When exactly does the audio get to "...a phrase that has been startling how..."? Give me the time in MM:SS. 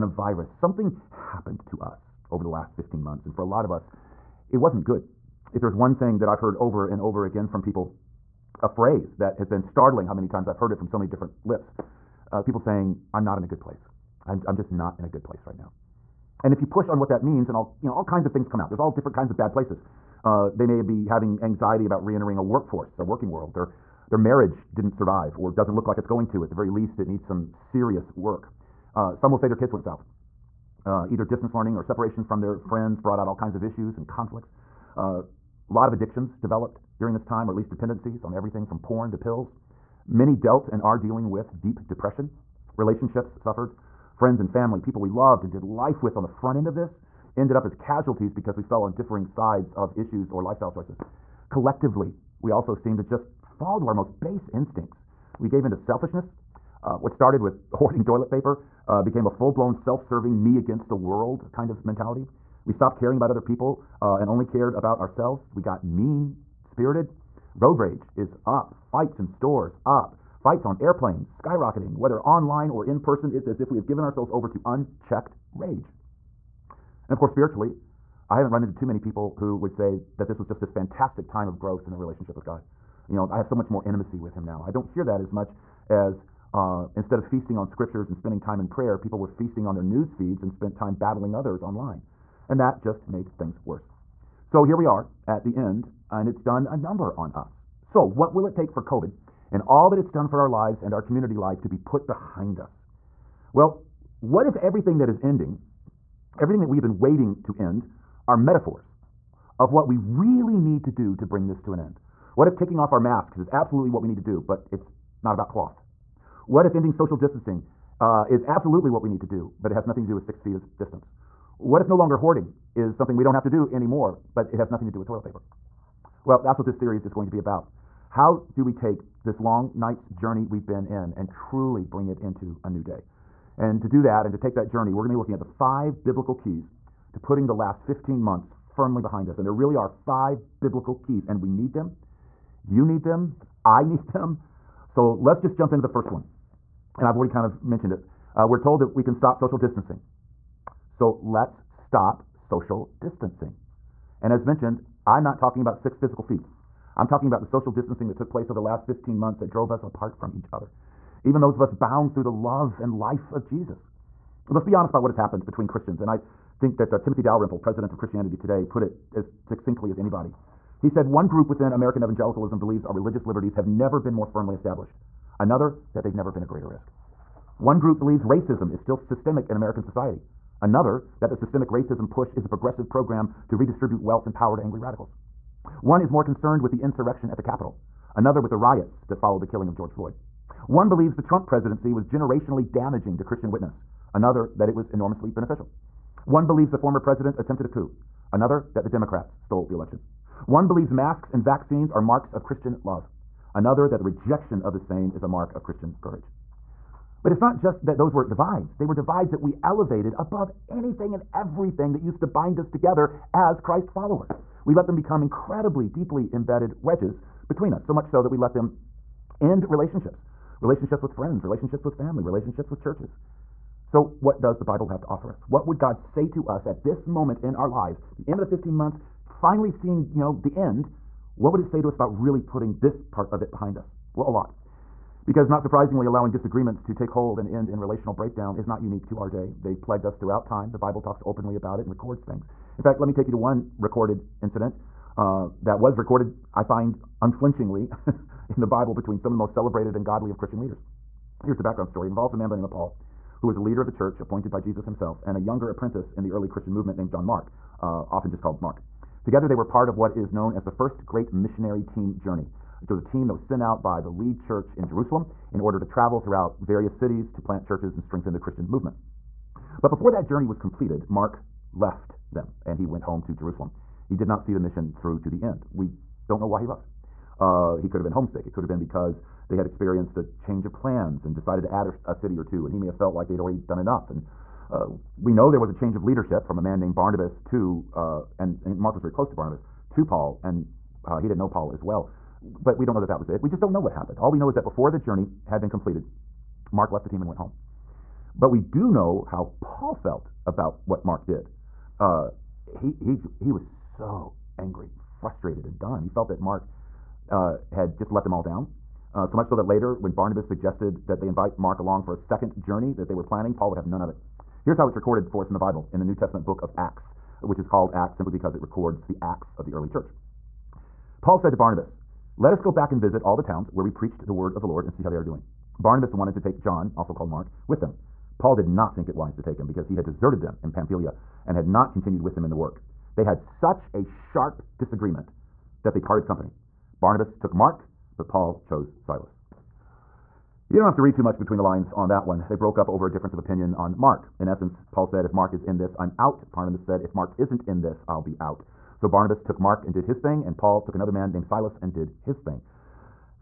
00:08.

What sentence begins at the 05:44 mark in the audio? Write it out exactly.
In essence, Paul said, if Mark is in this, I'm out.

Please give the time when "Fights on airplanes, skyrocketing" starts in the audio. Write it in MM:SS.
01:10.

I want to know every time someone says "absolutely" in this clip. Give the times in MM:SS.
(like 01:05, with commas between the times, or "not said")
01:53, 01:58.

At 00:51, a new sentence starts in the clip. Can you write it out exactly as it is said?
Collectively, we also seem to just fall to our most base instincts.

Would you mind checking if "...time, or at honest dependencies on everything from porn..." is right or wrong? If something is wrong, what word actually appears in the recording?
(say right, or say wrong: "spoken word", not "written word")
wrong: "least", not "honest".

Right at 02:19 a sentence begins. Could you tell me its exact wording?
And there really are five biblical keys, and we need them you need them.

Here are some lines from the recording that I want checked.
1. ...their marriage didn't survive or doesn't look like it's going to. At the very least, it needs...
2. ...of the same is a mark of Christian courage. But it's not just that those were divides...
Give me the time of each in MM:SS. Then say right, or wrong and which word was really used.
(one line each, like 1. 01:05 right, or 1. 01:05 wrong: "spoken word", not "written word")
1. 00:24 right
2. 03:24 right.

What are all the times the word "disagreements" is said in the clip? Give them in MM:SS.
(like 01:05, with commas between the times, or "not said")
03:56, 05:34.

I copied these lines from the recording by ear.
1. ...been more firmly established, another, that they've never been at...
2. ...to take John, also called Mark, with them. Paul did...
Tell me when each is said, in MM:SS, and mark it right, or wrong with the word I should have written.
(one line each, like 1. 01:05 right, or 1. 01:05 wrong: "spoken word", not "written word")
1. 02:53 right
2. 05:26 right.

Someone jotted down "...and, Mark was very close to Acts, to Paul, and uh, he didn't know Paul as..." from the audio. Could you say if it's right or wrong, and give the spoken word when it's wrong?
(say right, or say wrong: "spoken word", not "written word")
wrong: "Barnabas", not "Acts".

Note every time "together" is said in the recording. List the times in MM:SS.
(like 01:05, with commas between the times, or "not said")
03:32, 04:19.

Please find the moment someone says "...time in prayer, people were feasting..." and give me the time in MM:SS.
01:28.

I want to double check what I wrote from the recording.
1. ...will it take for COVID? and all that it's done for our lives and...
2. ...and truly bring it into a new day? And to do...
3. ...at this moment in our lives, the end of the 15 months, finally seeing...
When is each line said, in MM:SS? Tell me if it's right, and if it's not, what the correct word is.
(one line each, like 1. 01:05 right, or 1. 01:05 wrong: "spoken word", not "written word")
1. 01:38 right
2. 02:11 right
3. 03:46 right.